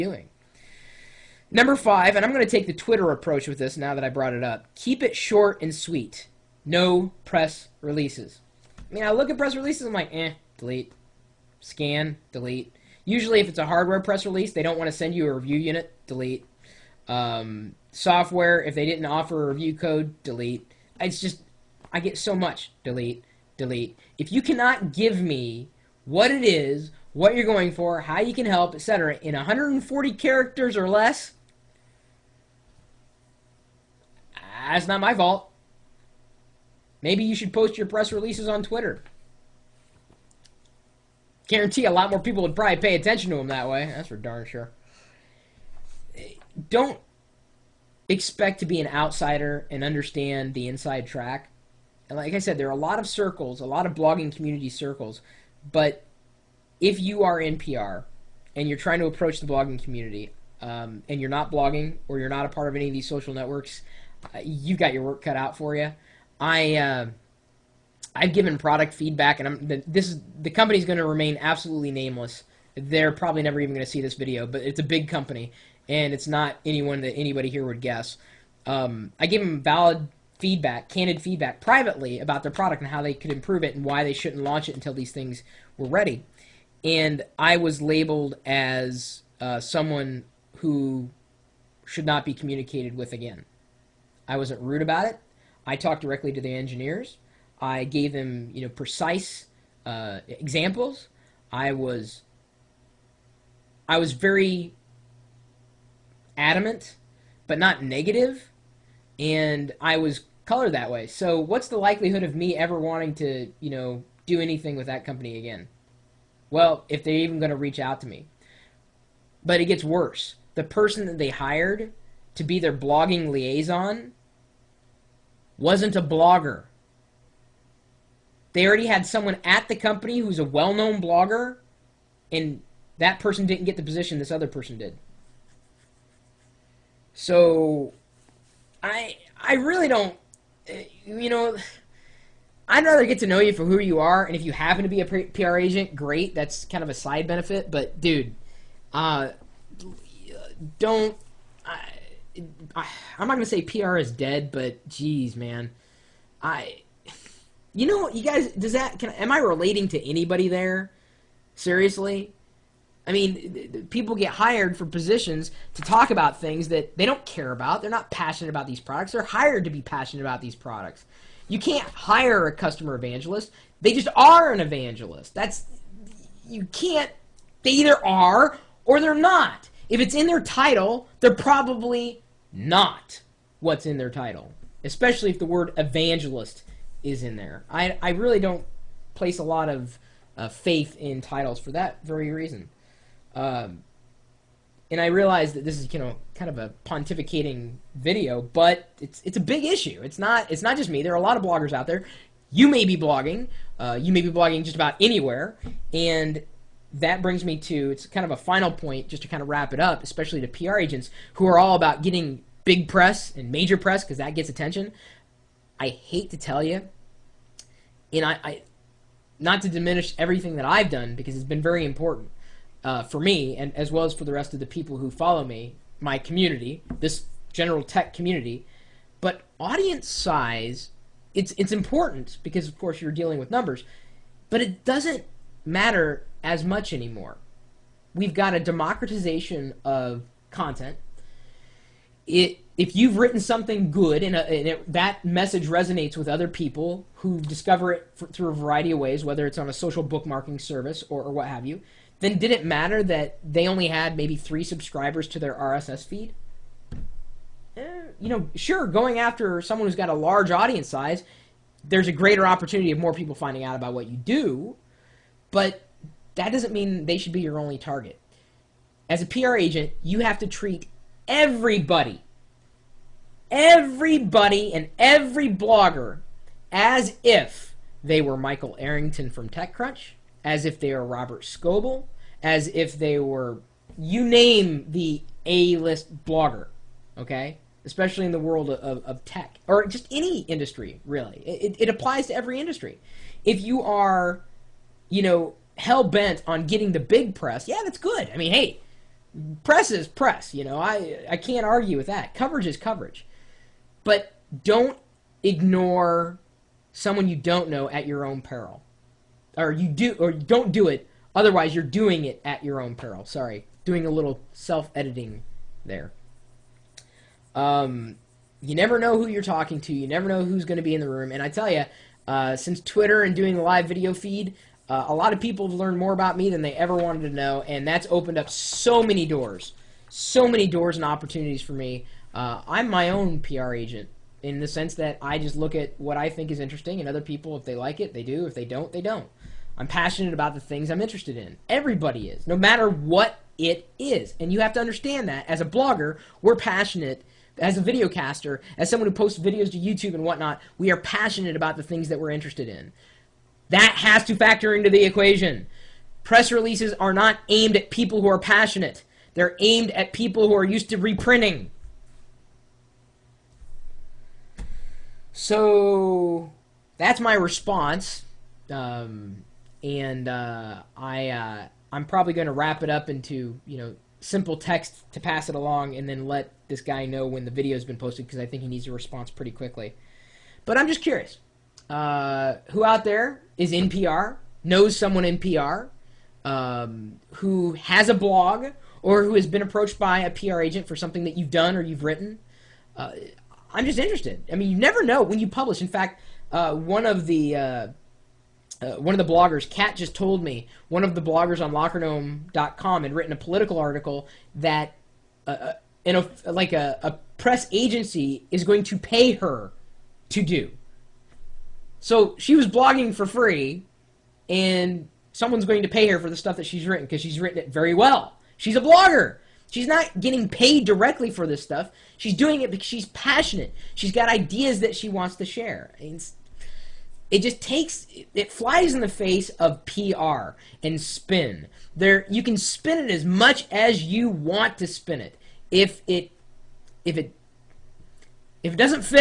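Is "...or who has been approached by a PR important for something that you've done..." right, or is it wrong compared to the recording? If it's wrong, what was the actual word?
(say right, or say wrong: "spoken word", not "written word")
wrong: "agent", not "important".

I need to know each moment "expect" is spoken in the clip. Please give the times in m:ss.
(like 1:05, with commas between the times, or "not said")
0:48.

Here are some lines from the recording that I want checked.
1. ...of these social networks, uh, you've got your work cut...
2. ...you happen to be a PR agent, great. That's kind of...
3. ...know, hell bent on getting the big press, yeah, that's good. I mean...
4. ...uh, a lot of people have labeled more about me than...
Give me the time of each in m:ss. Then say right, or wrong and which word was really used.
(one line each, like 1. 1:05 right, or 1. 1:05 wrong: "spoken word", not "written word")
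1. 1:02 right
2. 2:24 right
3. 4:55 right
4. 5:24 wrong: "learned", not "labeled".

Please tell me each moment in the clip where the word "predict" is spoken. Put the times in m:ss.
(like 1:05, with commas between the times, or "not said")
not said.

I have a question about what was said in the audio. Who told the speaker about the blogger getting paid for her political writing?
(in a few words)
Kat.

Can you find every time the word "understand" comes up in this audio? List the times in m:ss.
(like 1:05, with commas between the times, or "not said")
0:49, 5:44.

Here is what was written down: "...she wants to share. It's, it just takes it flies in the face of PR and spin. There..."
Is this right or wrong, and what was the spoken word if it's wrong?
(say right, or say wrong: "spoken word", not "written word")
right.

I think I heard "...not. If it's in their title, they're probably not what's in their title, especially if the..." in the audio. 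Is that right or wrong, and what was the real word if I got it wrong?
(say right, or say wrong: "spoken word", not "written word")
right.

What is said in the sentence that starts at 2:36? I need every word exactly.
I you know, you guys, does that?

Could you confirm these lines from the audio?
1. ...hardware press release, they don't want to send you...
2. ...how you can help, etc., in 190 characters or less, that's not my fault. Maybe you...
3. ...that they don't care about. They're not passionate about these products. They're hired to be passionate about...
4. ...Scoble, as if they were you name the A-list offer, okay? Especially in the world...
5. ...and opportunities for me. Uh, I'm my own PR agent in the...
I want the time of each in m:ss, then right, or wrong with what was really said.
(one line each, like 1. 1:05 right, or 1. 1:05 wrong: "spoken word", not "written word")
1. 0:13 right
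2. 0:28 wrong: "140", not "190"
3. 2:46 right
4. 4:41 wrong: "blogger", not "offer"
5. 5:30 right.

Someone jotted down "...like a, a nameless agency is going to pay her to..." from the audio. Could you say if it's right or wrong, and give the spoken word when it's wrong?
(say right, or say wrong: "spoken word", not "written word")
wrong: "press", not "nameless".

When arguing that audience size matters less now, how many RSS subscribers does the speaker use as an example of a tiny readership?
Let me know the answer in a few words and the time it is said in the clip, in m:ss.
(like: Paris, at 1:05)
3, at 4:14.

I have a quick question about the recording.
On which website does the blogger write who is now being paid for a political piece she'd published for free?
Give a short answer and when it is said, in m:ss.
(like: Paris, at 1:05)
LockerGnome.com, at 6:41.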